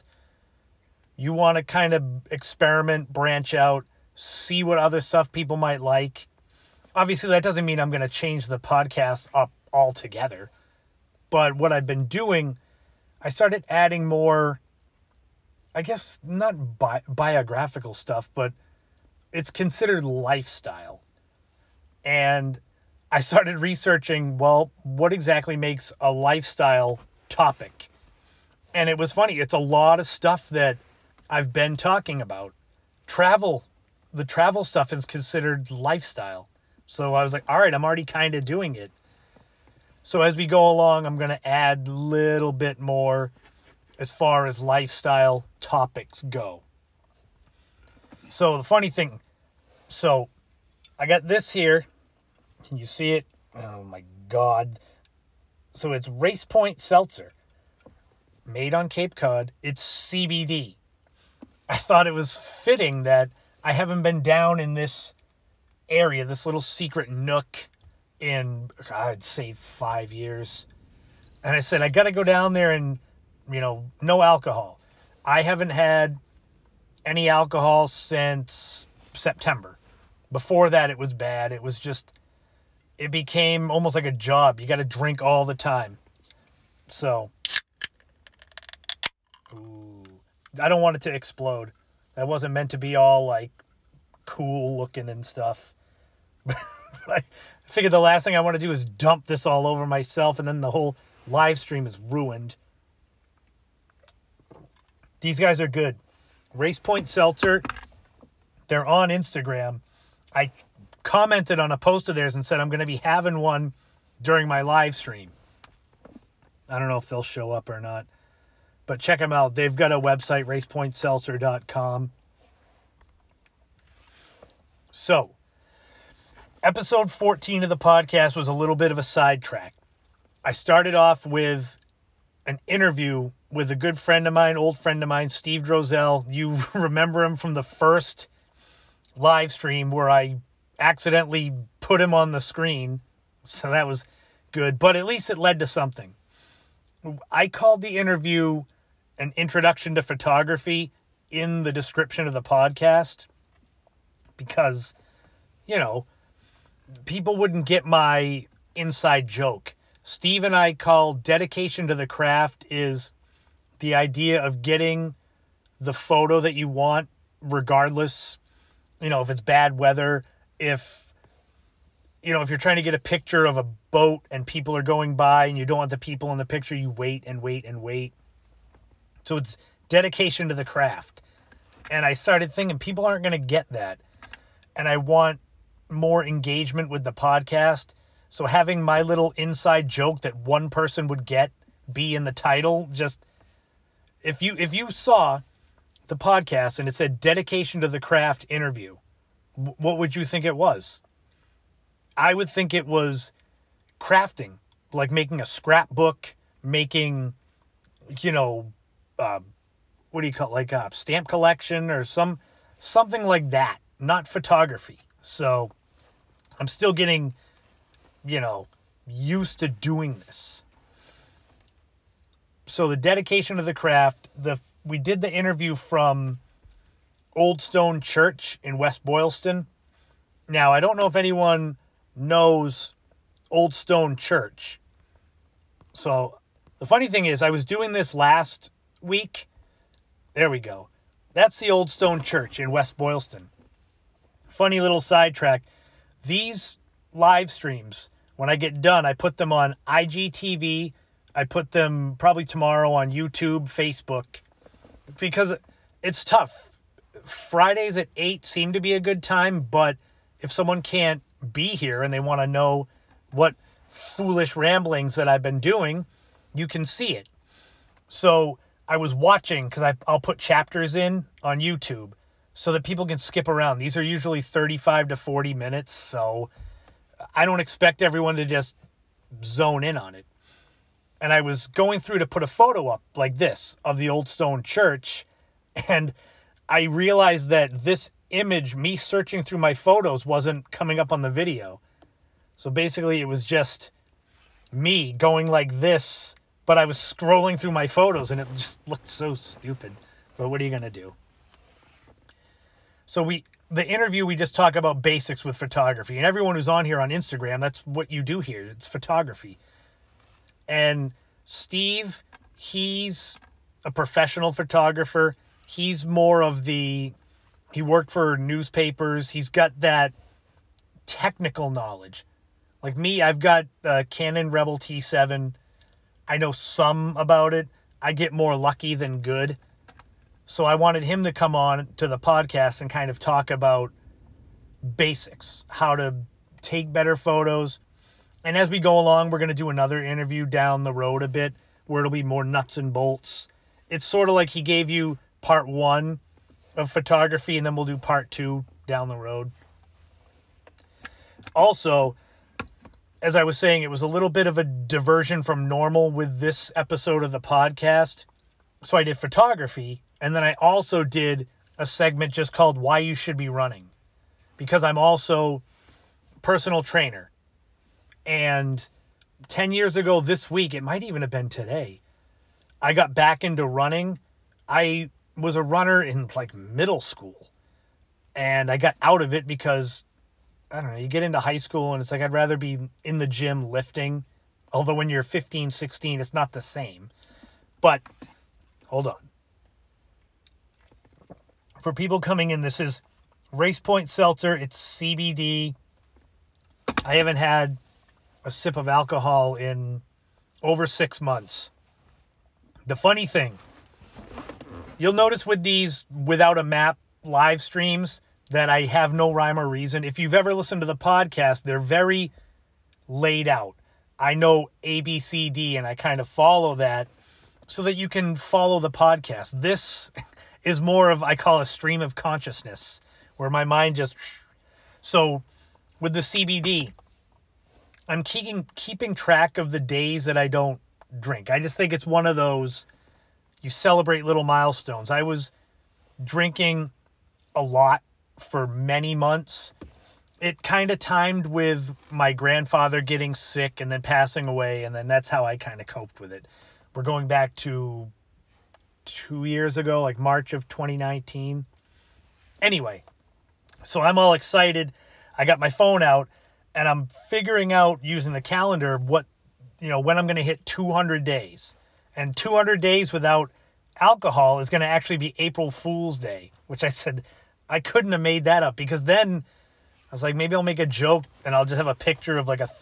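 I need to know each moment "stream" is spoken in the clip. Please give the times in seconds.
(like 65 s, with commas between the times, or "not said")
101 s, 114 s, 139 s, 247 s, 407 s, 421 s.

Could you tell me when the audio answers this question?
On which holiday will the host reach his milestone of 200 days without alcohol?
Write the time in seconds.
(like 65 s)
465 s.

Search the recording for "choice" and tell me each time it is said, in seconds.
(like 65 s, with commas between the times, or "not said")
not said.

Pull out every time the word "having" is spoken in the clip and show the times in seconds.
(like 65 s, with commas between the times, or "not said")
112 s, 188 s.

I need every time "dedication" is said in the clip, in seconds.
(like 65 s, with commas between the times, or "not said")
161 s, 179 s, 197 s, 222 s.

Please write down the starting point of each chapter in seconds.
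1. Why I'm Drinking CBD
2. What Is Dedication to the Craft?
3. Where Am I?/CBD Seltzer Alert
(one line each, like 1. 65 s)
1. 350 s
2. 126 s
3. 47 s.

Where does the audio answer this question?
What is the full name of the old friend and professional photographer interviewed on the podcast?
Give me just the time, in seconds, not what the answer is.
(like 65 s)
135 s.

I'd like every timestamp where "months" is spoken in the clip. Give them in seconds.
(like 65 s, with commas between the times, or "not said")
401 s, 439 s.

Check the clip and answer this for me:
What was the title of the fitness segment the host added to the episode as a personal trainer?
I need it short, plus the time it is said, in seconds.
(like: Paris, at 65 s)
Why You Should Be Running, at 362 s.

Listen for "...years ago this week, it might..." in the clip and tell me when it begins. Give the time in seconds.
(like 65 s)
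369 s.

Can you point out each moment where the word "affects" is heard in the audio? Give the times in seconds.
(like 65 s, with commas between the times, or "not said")
not said.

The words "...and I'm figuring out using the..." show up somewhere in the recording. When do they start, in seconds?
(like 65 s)
456 s.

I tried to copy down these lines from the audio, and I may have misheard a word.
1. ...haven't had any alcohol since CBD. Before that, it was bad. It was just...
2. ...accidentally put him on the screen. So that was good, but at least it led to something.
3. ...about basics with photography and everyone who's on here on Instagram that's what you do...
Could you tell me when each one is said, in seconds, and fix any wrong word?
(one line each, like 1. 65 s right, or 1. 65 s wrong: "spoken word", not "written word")
1. 75 s wrong: "September", not "CBD"
2. 140 s right
3. 304 s right.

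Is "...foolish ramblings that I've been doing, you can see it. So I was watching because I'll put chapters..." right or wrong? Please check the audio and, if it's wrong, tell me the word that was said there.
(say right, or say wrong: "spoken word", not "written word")
right.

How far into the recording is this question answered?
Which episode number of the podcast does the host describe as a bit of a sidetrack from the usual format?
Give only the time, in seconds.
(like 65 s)
126 s.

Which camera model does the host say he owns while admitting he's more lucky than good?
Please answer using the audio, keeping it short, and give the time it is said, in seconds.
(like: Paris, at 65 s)
Canon Rebel T7, at 324 s.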